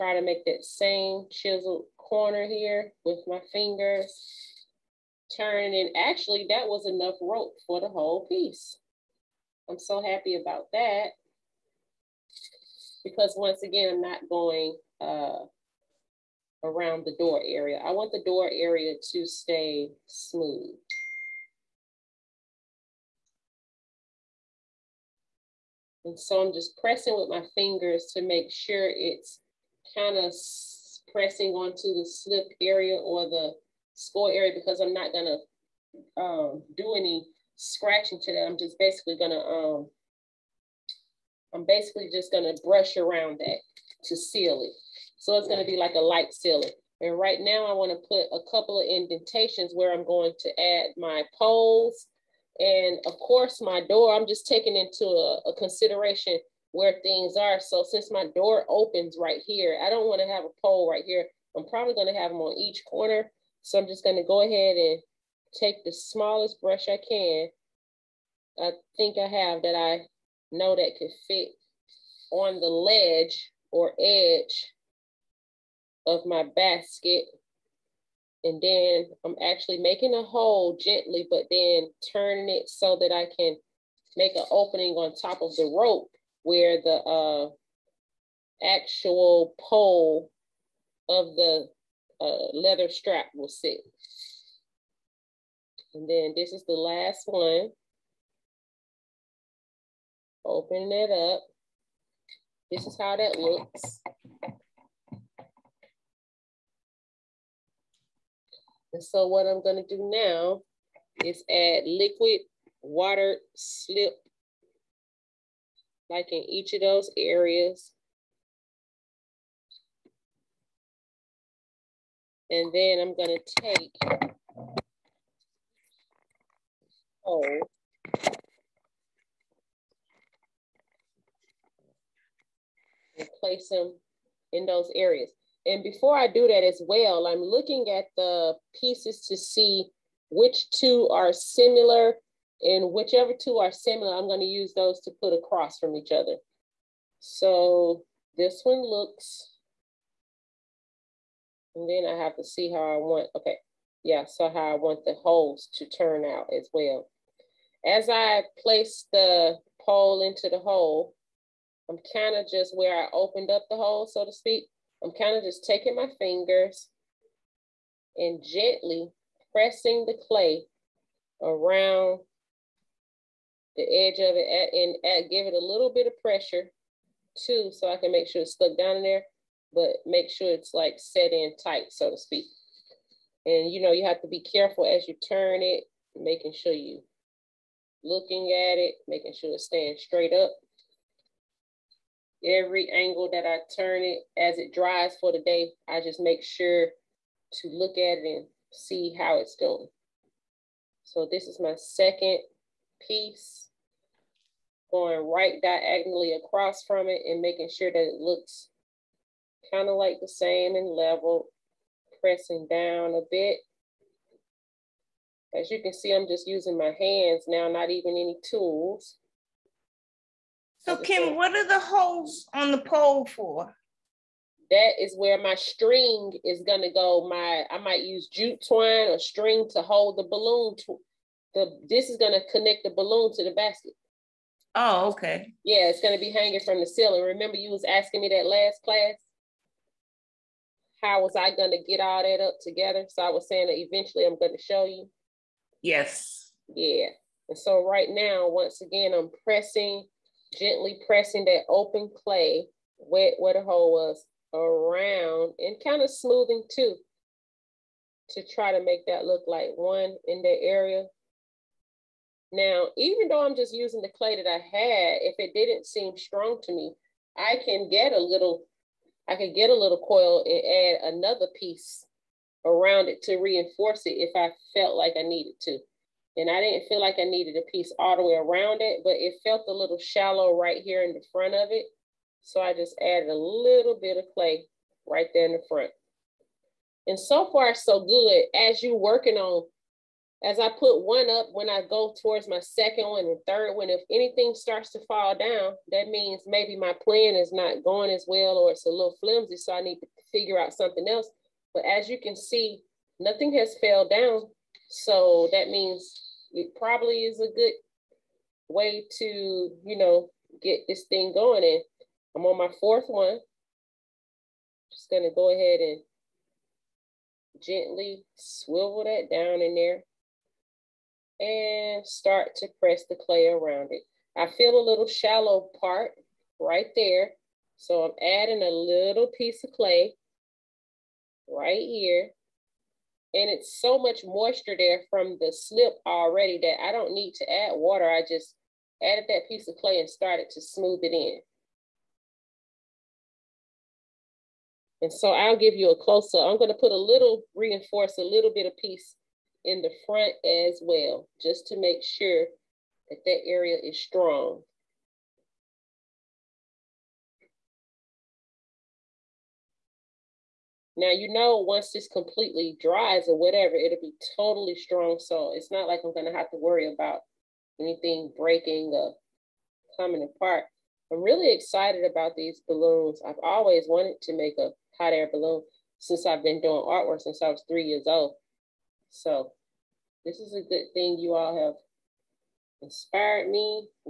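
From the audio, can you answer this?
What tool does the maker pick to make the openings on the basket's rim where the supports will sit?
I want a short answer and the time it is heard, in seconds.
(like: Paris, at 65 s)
smallest brush, at 65 s.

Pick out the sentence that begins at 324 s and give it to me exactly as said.
I feel a little shallow part right there.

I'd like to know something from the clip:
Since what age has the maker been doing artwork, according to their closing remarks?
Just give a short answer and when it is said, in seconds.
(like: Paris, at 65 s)
3 years old, at 377 s.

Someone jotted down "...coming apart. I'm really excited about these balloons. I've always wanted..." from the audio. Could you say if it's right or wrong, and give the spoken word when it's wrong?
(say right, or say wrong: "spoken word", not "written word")
right.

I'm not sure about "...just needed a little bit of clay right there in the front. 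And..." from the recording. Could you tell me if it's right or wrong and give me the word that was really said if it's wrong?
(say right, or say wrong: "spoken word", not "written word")
wrong: "added", not "needed".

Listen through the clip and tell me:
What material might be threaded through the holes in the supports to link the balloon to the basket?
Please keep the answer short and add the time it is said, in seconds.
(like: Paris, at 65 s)
jute twine, at 228 s.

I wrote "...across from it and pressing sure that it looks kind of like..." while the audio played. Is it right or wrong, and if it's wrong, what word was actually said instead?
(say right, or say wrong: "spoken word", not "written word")
wrong: "making", not "pressing".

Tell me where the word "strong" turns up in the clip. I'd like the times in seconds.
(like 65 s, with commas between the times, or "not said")
266 s, 354 s, 364 s.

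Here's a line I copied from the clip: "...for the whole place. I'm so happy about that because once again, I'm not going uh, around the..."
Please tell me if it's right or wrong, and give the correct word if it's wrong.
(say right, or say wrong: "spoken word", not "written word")
wrong: "piece", not "place".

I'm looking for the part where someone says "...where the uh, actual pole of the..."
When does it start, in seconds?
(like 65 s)
86 s.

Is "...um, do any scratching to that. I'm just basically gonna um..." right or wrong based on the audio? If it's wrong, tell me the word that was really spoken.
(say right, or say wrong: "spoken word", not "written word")
right.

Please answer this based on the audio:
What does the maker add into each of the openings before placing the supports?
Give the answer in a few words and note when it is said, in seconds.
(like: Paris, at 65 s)
liquid water slip, at 111 s.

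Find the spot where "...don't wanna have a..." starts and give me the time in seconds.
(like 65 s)
59 s.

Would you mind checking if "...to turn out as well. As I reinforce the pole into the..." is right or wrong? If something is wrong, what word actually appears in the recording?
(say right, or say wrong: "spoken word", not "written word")
wrong: "place", not "reinforce".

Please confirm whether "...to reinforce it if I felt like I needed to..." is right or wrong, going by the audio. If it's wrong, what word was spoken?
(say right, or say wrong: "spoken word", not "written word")
right.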